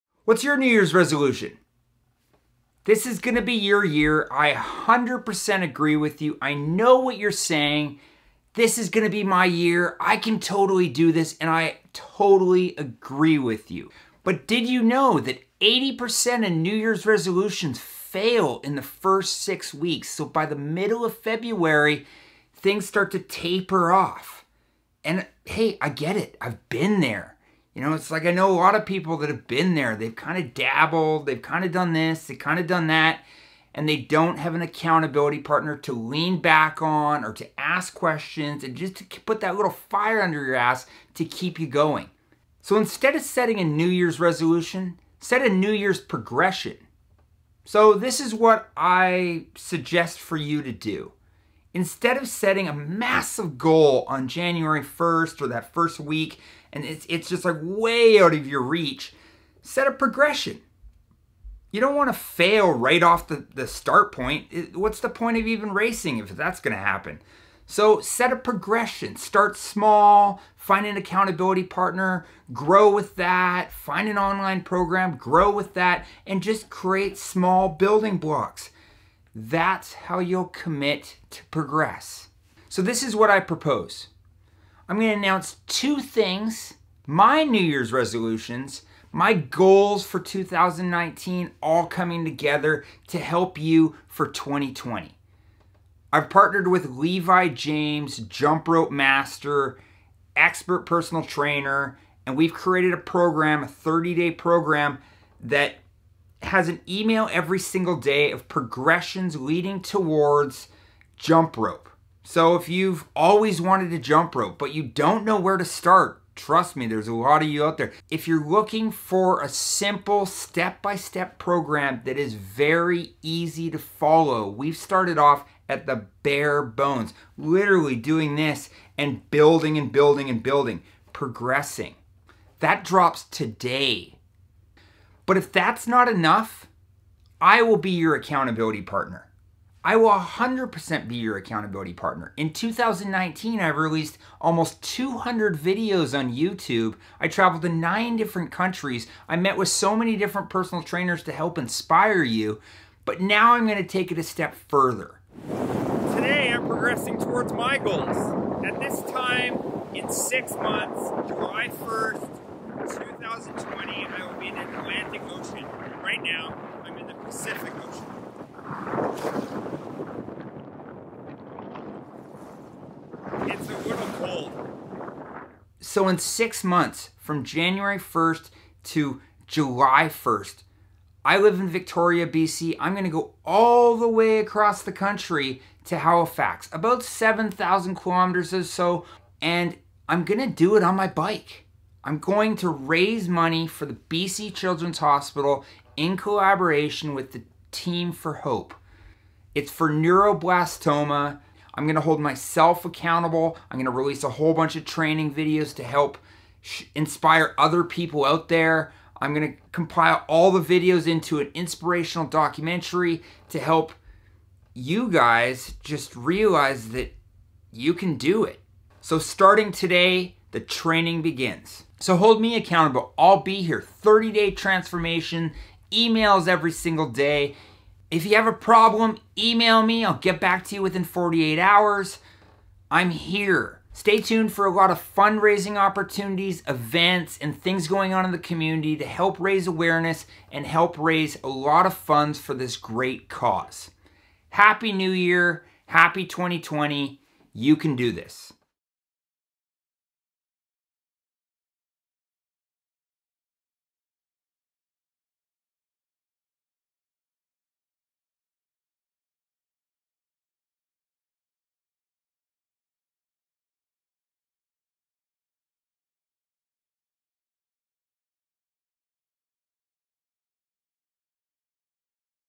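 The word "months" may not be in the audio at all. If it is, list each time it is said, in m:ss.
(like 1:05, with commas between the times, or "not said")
2:40, 2:56.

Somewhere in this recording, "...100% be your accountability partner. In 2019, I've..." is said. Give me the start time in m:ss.
2:20.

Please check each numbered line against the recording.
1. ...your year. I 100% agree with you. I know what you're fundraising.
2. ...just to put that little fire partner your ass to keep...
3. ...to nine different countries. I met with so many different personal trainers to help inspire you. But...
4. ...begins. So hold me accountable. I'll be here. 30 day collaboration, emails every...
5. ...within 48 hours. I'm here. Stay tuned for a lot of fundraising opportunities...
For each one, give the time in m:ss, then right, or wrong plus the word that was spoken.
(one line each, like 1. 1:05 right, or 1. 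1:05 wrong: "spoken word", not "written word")
1. 0:03 wrong: "saying", not "fundraising"
2. 0:38 wrong: "under", not "partner"
3. 2:27 right
4. 3:41 wrong: "transformation", not "collaboration"
5. 3:50 right.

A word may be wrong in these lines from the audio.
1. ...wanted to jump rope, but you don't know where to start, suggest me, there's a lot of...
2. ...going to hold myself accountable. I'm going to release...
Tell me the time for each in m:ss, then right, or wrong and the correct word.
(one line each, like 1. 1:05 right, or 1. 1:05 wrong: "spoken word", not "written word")
1. 1:53 wrong: "trust", not "suggest"
2. 3:21 right.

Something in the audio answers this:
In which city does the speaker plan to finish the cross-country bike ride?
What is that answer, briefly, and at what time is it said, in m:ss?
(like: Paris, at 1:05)
Halifax, at 3:05.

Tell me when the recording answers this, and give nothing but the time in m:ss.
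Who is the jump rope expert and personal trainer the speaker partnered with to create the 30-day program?
1:36.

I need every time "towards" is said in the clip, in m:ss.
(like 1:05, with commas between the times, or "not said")
1:49, 2:37.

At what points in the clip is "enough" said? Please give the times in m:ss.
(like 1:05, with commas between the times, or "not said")
2:16.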